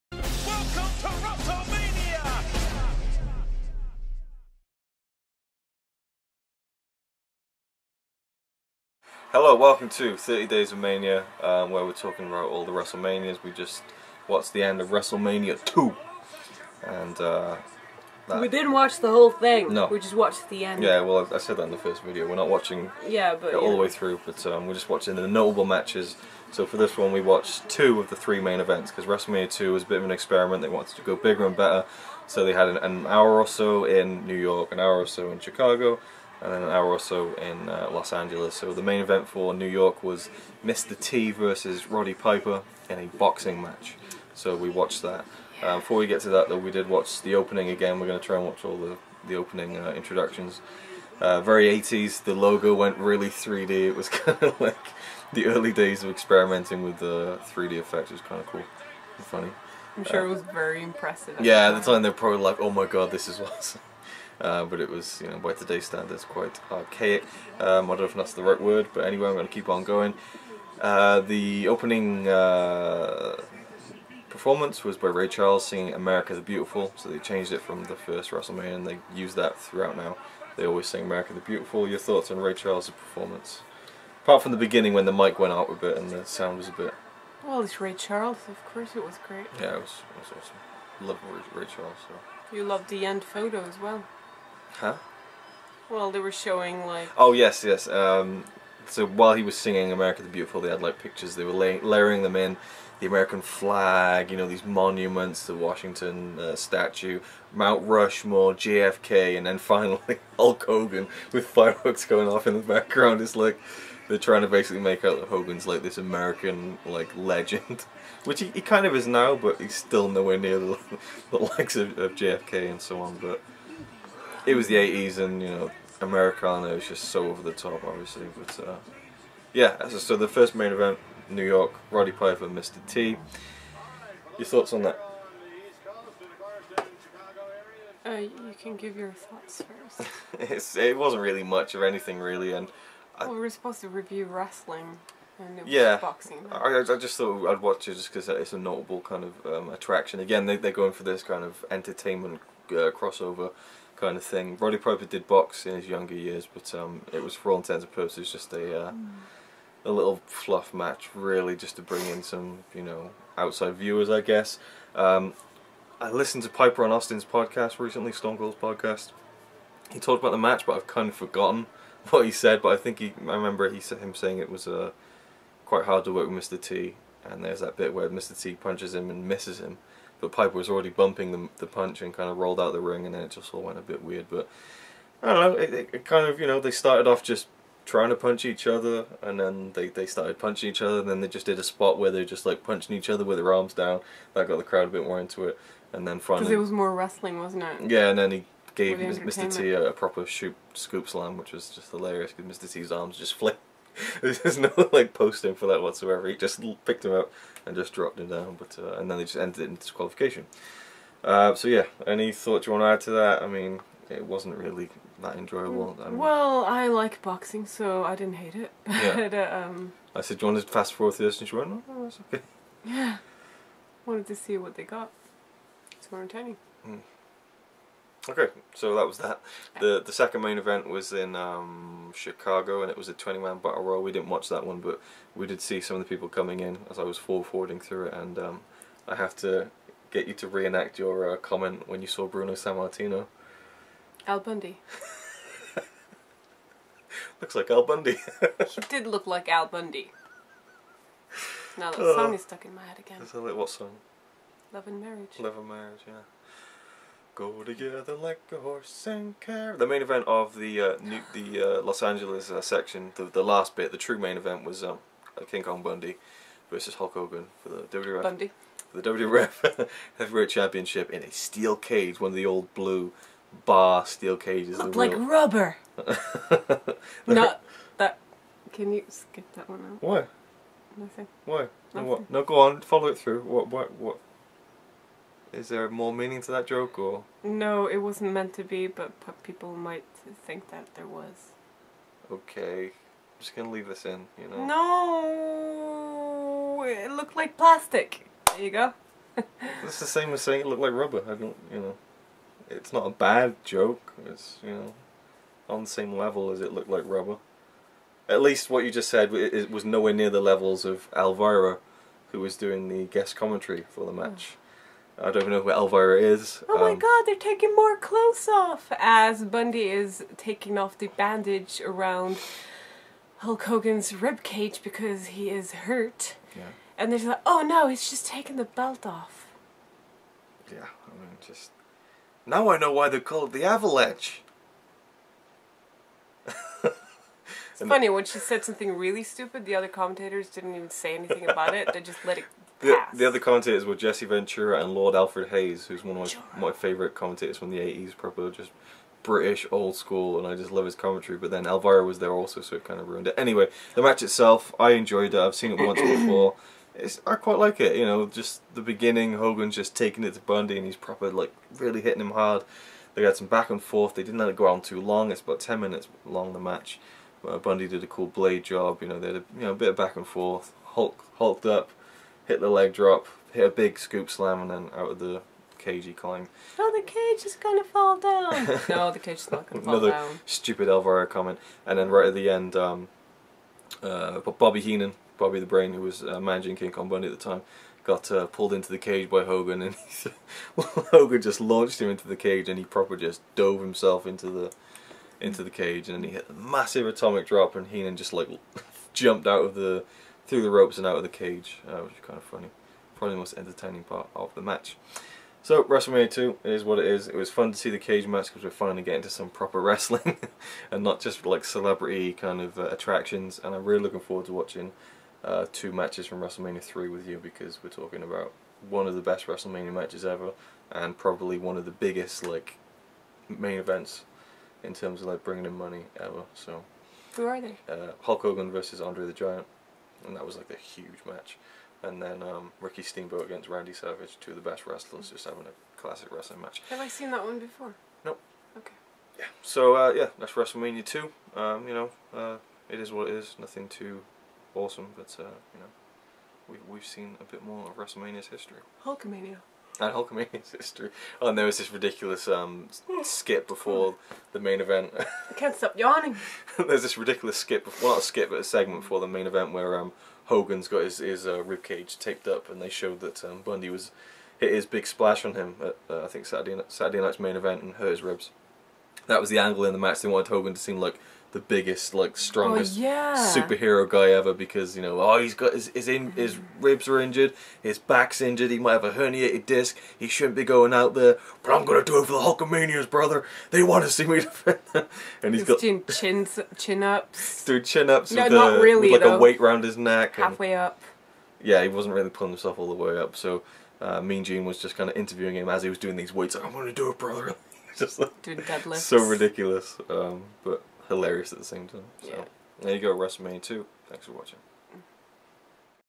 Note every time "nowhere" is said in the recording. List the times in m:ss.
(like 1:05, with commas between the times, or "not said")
2:00, 5:09.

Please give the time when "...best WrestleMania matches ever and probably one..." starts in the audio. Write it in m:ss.
6:59.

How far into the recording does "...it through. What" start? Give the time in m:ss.
4:43.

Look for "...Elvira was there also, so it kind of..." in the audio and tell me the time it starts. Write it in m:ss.
5:51.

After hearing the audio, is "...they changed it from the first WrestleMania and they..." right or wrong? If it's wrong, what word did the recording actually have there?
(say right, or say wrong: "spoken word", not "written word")
right.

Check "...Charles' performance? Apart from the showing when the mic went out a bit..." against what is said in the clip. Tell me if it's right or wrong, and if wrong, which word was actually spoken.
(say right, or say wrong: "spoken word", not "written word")
wrong: "beginning", not "showing".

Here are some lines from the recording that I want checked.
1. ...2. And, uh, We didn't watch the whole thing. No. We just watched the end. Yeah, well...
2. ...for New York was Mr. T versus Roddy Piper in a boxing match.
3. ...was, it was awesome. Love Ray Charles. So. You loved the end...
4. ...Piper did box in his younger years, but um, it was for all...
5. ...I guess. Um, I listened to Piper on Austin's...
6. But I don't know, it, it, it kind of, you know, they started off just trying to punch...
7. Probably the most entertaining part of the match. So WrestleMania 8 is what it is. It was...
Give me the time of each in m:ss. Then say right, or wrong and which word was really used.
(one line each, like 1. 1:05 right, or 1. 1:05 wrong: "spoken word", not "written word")
1. 0:15 right
2. 0:39 right
3. 1:29 right
4. 2:34 right
5. 2:44 right
6. 3:04 right
7. 6:43 wrong: "2", not "8".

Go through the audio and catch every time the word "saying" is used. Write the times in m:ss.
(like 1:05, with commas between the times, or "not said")
2:54, 5:00.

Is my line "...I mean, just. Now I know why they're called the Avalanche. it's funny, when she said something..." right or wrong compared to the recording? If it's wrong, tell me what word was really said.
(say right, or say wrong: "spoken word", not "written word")
right.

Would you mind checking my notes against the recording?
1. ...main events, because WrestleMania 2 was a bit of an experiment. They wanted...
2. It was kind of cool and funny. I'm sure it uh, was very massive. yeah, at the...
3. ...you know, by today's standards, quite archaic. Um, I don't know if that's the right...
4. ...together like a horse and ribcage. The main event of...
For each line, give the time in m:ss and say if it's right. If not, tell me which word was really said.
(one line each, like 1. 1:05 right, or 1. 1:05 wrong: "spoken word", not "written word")
1. 0:28 right
2. 0:58 wrong: "impressive", not "massive"
3. 1:05 right
4. 4:17 wrong: "carriage", not "ribcage".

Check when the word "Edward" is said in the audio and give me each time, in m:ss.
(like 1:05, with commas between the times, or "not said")
not said.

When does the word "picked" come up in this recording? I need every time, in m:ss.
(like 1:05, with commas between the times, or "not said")
3:26.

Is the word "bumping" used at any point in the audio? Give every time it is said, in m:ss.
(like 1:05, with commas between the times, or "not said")
3:00.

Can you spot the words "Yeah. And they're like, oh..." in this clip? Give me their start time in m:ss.
5:26.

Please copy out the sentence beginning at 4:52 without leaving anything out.
Okay, I'm just gonna leave this in, you know.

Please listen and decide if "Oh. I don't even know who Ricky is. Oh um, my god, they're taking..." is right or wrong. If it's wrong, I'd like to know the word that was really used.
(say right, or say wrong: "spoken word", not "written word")
wrong: "Elvira", not "Ricky".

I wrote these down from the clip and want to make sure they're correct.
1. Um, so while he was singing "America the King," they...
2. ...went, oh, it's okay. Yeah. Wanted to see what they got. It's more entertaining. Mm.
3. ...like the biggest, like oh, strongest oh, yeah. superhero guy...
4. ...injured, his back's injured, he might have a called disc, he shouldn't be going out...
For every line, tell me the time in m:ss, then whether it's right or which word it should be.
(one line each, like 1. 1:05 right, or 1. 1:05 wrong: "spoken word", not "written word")
1. 1:37 wrong: "Beautiful", not "King"
2. 3:41 right
3. 7:50 right
4. 7:57 wrong: "herniated", not "called".